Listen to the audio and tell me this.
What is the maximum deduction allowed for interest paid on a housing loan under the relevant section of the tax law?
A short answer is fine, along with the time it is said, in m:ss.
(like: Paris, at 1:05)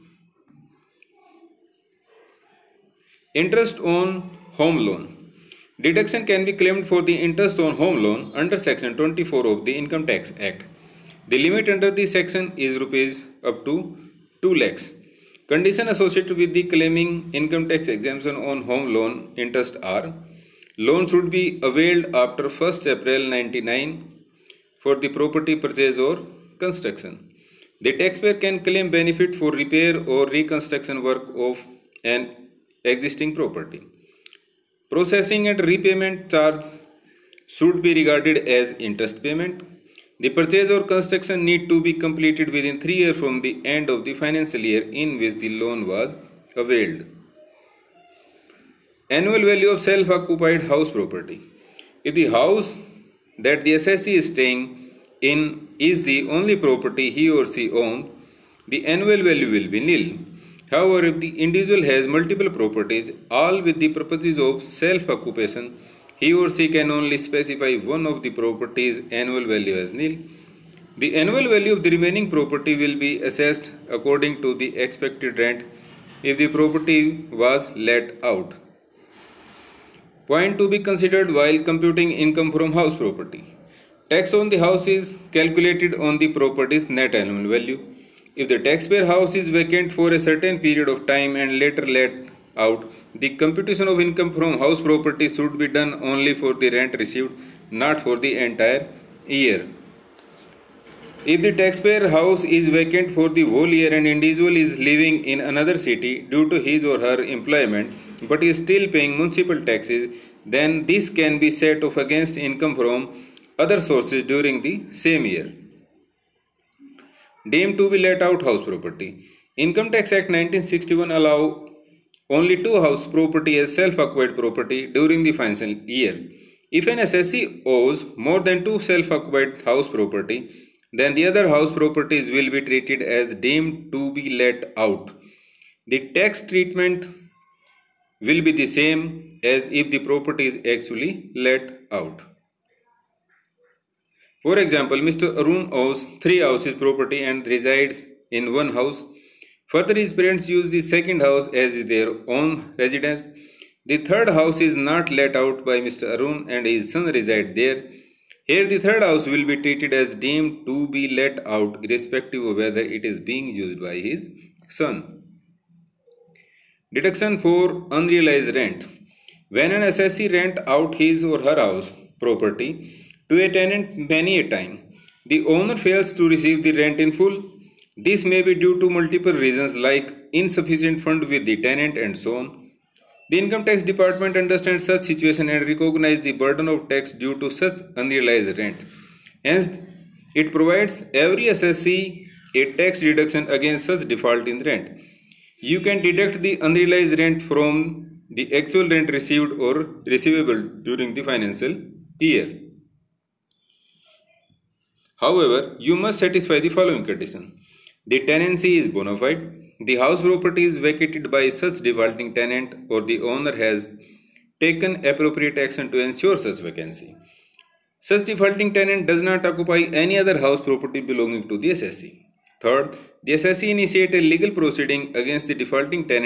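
2 lakhs, at 0:14.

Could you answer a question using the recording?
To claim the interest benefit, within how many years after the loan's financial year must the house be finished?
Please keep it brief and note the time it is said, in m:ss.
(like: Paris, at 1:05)
3 years, at 0:42.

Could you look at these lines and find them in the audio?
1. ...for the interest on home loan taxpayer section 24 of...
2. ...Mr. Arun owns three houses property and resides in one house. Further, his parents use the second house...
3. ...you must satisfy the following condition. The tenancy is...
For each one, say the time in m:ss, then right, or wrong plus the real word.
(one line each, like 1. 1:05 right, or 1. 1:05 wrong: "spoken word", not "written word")
1. 0:06 wrong: "under", not "taxpayer"
2. 2:24 right
3. 3:25 right.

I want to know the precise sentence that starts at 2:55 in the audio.
The owner fails to receive the rent in full.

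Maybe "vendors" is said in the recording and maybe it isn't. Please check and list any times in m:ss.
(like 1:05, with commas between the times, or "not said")
not said.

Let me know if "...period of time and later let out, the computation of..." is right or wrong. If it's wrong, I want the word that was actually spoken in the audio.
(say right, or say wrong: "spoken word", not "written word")
right.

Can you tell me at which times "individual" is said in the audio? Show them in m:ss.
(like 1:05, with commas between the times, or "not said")
1:01, 1:44.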